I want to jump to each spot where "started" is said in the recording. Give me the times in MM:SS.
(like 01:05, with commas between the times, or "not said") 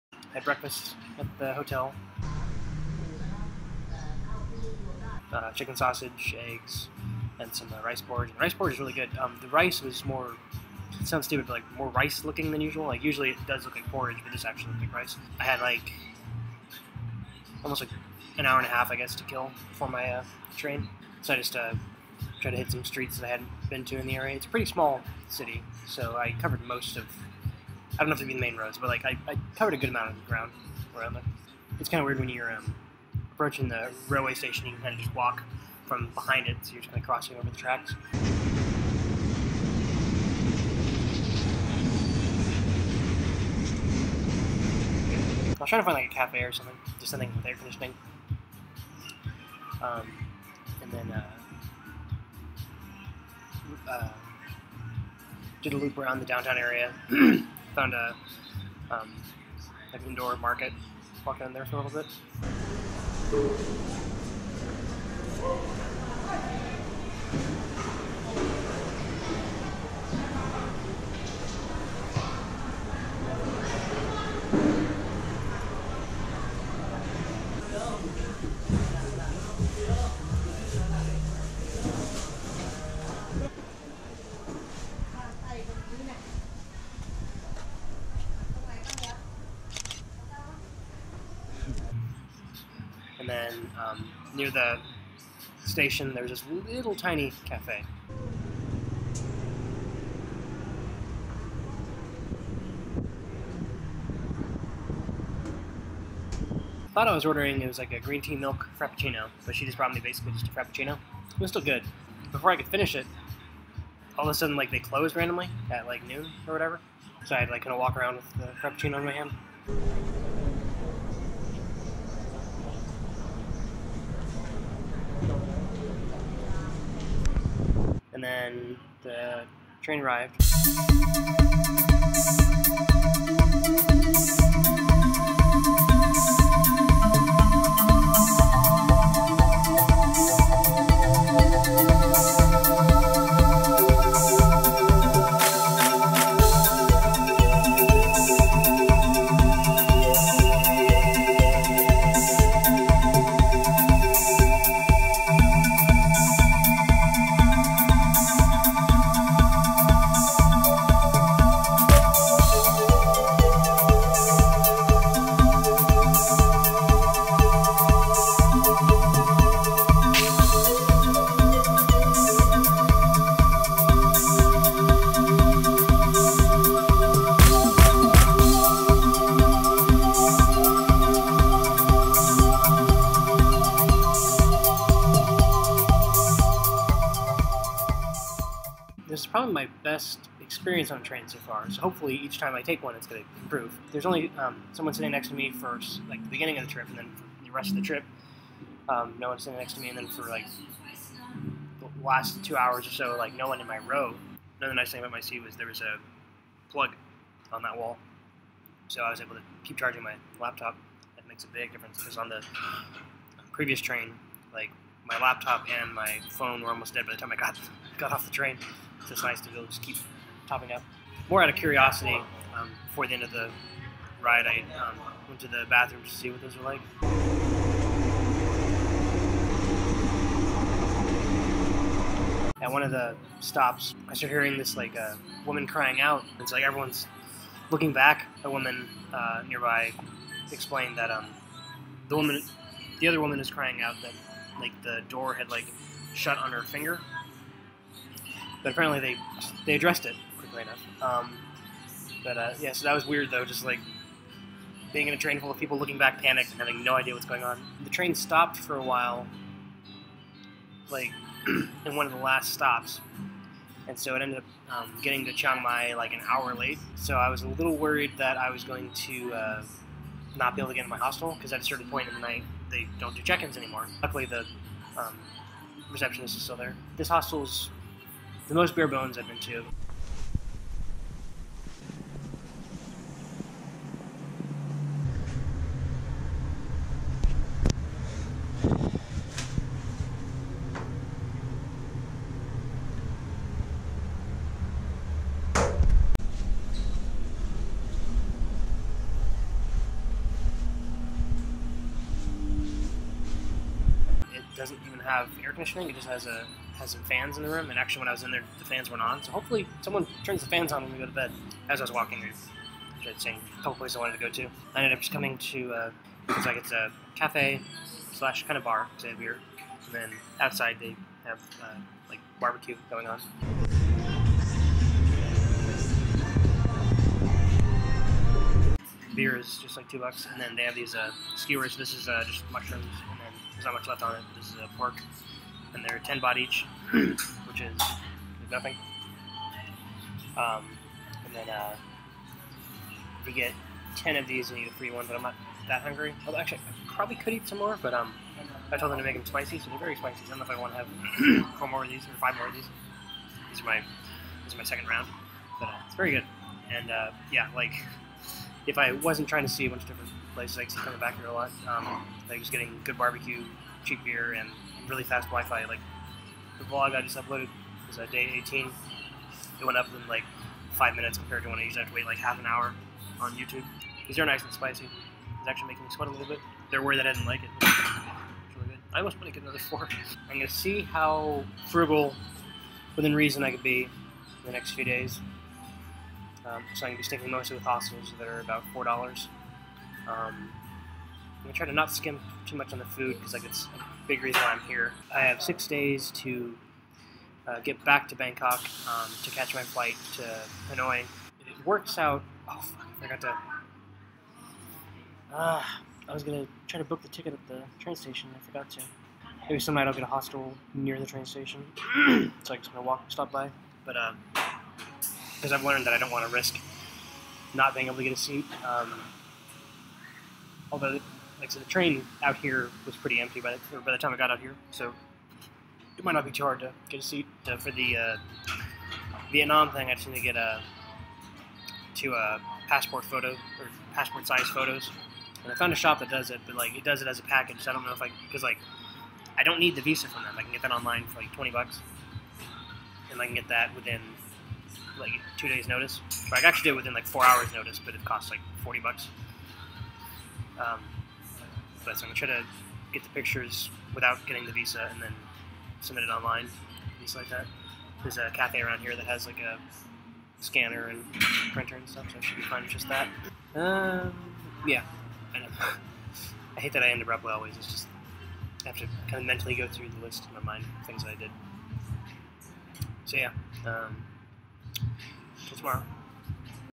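03:54.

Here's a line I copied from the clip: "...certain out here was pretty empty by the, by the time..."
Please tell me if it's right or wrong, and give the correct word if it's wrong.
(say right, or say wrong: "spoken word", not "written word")
wrong: "train", not "certain".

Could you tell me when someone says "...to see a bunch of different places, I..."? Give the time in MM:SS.
05:59.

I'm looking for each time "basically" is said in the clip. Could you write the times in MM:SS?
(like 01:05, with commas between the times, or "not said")
01:50.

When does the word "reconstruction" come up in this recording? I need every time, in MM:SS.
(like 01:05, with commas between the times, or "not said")
not said.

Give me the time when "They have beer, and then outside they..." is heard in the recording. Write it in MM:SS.
05:19.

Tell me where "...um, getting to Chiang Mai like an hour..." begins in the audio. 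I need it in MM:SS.
04:24.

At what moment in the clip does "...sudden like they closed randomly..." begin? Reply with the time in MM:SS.
01:54.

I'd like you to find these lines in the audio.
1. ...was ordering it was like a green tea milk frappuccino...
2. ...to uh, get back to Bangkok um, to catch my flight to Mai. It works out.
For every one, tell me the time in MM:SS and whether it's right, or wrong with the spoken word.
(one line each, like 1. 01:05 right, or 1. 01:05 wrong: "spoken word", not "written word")
1. 01:47 right
2. 06:36 wrong: "Hanoi", not "Mai".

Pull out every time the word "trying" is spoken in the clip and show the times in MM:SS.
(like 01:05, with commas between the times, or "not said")
00:45, 05:59.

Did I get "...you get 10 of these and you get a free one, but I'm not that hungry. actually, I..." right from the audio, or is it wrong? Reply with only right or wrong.
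right.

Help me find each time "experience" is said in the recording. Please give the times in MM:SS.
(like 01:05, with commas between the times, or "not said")
03:10.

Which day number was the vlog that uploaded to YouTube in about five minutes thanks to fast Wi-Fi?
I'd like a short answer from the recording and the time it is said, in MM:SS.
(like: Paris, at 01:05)
18, at 06:08.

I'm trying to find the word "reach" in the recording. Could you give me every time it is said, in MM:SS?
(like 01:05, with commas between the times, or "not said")
not said.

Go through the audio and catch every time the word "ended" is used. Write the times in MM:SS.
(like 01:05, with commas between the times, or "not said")
04:24, 05:14.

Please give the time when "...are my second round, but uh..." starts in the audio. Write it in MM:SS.
05:54.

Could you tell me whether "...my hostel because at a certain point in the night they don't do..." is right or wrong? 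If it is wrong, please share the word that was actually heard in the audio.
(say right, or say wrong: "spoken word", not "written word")
right.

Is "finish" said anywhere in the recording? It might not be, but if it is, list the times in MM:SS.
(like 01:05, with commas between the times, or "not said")
01:52.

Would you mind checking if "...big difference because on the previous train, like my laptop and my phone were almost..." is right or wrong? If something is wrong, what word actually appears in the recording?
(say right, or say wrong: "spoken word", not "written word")
right.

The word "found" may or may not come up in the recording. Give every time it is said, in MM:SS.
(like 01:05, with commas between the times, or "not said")
00:57, 07:15.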